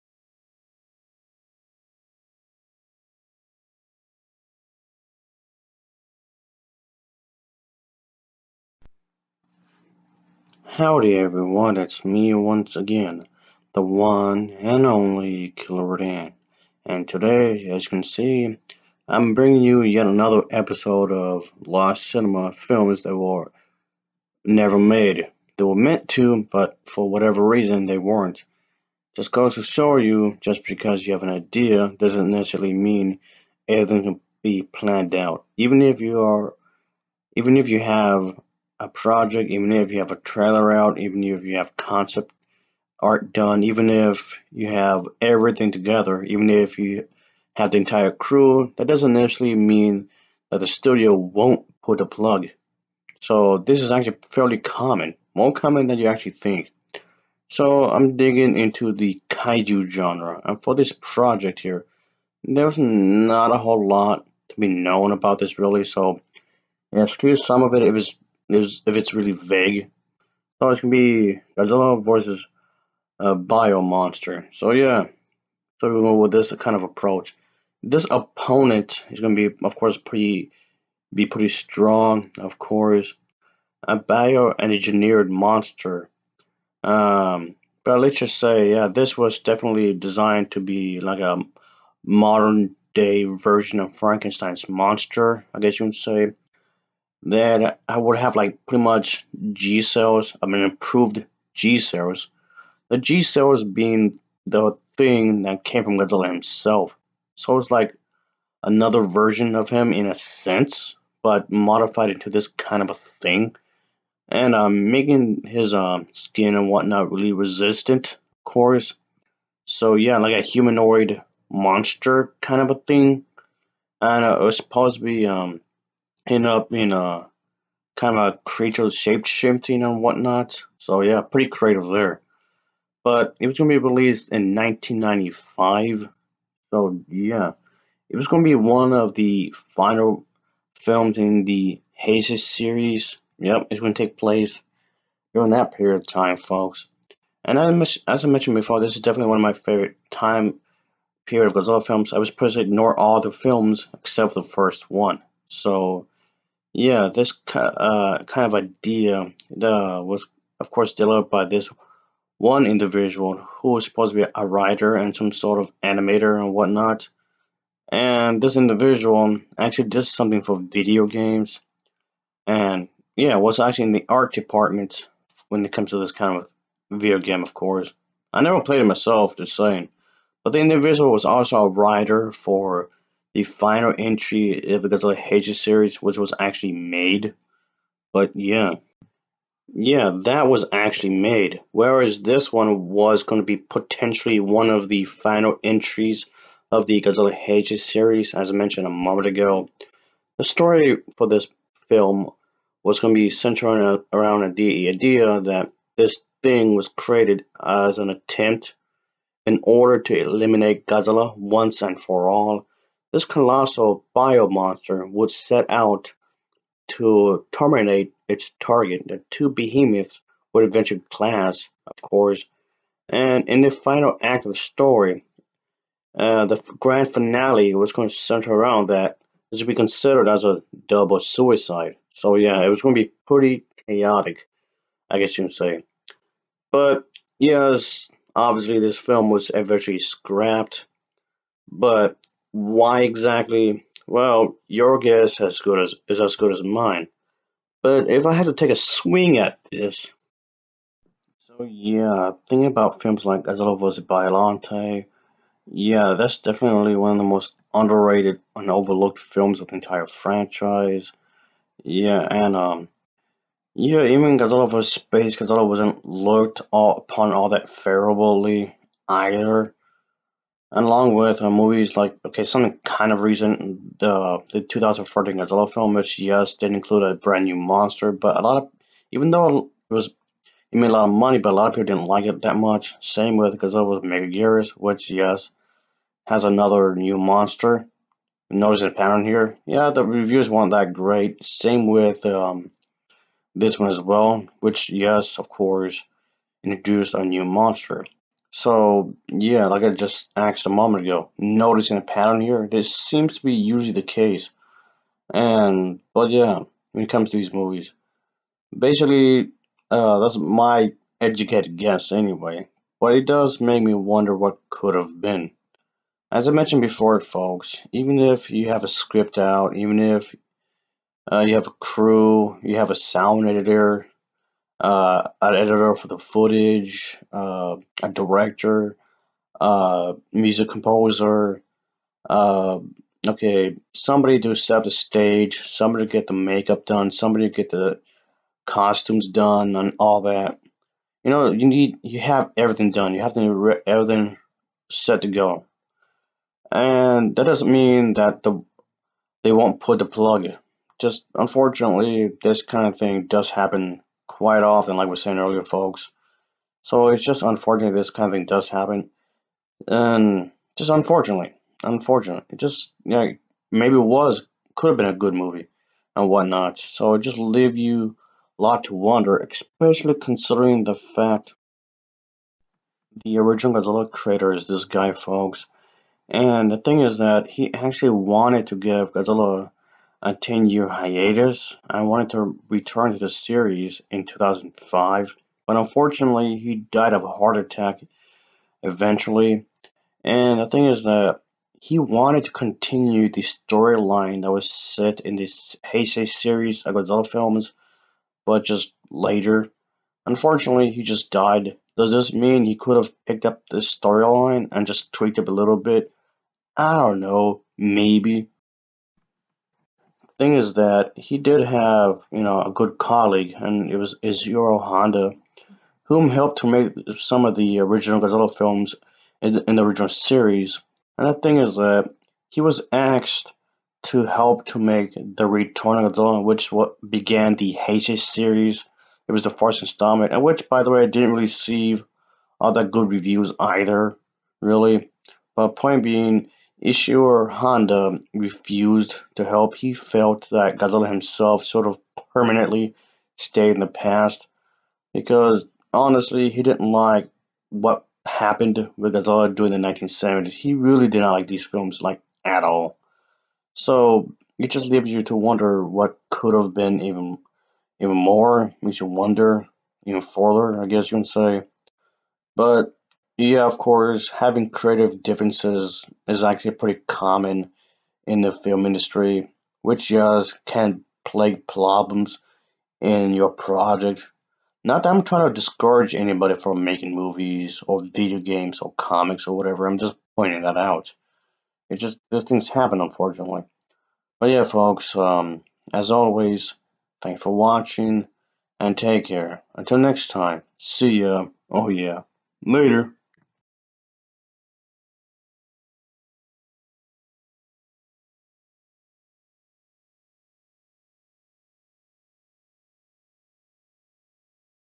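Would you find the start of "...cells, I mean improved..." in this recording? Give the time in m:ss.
1:39.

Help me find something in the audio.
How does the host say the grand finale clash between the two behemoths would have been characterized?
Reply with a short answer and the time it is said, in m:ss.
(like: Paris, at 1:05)
double suicide, at 3:50.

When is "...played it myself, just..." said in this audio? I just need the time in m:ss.
2:58.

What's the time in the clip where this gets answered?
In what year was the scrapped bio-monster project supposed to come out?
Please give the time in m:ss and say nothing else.
2:14.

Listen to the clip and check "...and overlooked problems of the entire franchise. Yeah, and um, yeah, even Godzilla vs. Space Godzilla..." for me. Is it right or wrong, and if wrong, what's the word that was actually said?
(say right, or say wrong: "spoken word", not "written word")
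wrong: "films", not "problems".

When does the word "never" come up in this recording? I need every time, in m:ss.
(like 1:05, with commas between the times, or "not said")
0:24, 2:58.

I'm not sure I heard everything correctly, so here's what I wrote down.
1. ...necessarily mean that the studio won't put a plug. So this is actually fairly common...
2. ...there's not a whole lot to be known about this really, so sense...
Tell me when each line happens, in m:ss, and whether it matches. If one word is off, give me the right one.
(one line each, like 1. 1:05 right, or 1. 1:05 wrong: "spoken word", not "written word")
1. 0:49 right
2. 1:02 wrong: "excuse", not "sense".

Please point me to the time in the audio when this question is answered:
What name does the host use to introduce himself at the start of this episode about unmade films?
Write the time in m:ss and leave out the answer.
0:15.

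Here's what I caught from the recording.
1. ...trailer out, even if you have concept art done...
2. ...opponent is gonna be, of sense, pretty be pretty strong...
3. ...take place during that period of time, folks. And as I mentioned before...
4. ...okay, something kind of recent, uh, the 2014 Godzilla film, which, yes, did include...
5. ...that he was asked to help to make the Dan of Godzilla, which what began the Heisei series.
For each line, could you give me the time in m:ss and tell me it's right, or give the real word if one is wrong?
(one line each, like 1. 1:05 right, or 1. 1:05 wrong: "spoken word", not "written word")
1. 0:40 right
2. 1:18 wrong: "course", not "sense"
3. 2:23 right
4. 4:32 right
5. 7:01 wrong: "Return", not "Dan".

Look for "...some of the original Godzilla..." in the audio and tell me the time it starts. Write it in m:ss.
6:57.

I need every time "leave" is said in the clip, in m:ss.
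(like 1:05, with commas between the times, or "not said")
6:07, 7:34.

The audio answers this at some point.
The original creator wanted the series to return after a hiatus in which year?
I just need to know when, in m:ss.
6:24.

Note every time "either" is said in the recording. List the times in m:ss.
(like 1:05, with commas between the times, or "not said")
4:29, 7:13.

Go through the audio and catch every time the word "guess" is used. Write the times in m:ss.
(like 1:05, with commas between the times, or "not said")
1:35, 3:55, 4:04, 5:11, 7:40.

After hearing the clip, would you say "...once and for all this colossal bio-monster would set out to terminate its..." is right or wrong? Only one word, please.
right.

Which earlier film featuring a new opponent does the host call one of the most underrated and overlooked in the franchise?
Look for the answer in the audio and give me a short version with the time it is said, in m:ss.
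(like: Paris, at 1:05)
Godzilla vs. Biolante, at 4:13.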